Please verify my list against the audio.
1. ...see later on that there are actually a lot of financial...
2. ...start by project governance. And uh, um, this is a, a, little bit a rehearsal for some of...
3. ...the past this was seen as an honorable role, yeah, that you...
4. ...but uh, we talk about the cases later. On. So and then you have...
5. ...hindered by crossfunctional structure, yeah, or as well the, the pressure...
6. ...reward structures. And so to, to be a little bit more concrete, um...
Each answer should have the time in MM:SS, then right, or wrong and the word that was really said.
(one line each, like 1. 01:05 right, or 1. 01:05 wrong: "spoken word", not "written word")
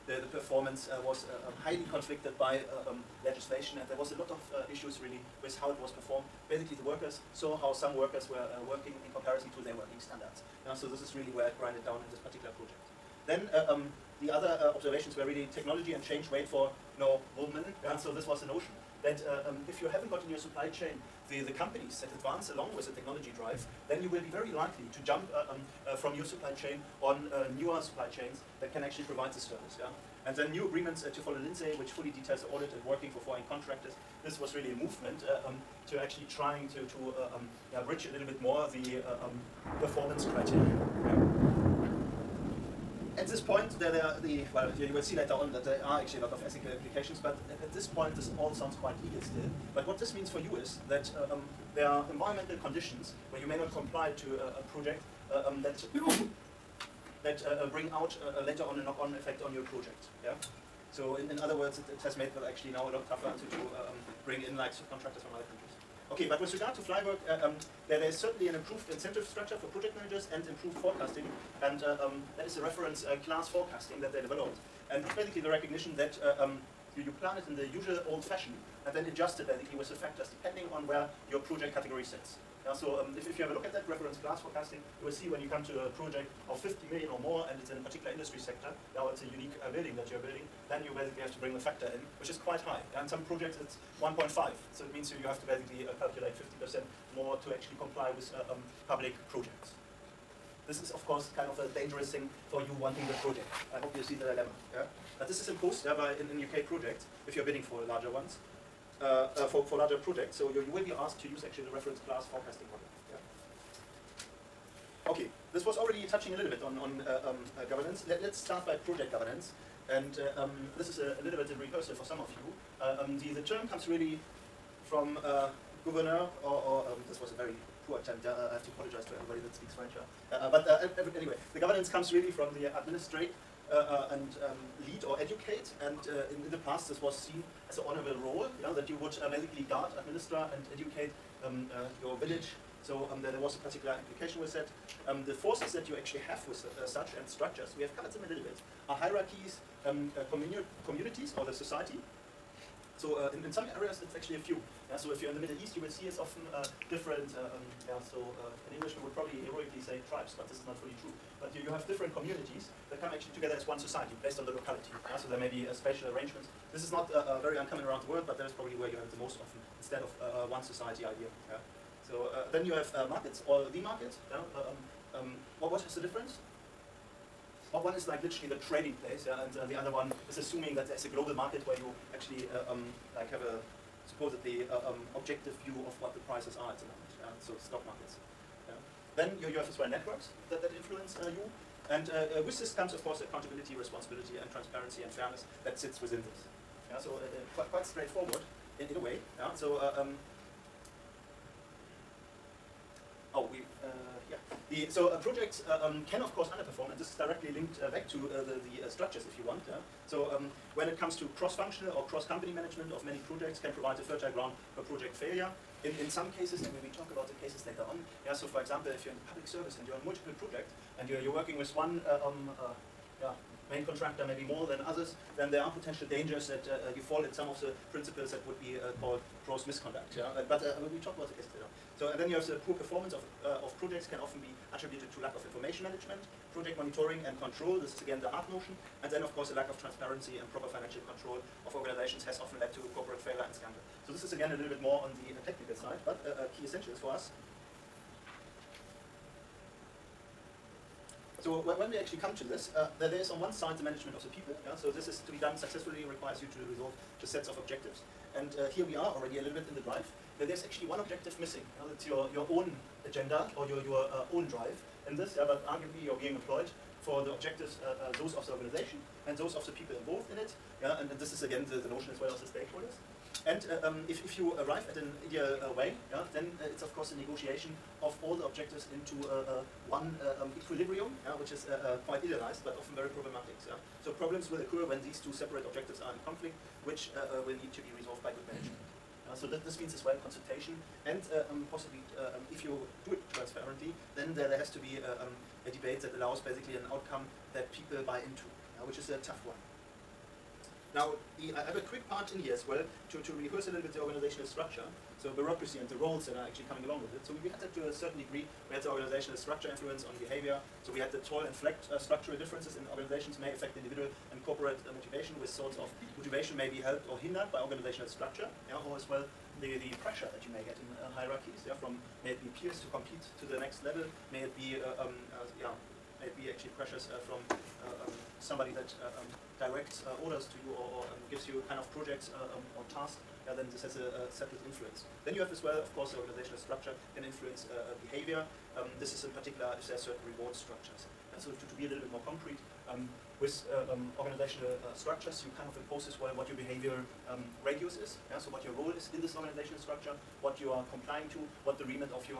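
1. 00:45 wrong: "ethical", not "financial"
2. 01:58 right
3. 02:16 right
4. 03:50 right
5. 05:17 wrong: "organizational", not "crossfunctional"
6. 05:40 right.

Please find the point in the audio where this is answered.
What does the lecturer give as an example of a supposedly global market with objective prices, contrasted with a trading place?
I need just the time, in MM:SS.
03:07.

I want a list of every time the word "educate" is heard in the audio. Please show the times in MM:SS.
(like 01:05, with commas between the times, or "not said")
02:15, 02:20.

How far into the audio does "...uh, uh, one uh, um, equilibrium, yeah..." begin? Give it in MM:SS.
04:39.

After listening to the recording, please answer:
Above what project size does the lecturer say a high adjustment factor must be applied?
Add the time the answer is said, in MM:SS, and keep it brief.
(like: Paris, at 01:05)
50 million, at 01:26.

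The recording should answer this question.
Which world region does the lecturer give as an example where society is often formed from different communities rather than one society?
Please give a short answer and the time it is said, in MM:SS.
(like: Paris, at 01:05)
Middle East, at 02:35.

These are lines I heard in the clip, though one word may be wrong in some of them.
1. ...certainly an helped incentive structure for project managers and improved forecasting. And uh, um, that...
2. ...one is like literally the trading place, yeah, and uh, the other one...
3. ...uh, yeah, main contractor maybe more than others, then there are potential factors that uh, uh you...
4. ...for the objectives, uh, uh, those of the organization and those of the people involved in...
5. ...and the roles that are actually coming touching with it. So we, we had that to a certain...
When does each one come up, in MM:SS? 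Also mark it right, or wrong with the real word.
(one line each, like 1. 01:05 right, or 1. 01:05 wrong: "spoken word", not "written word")
1. 01:08 wrong: "improved", not "helped"
2. 02:57 right
3. 03:42 wrong: "dangers", not "factors"
4. 04:27 right
5. 05:05 wrong: "along", not "touching".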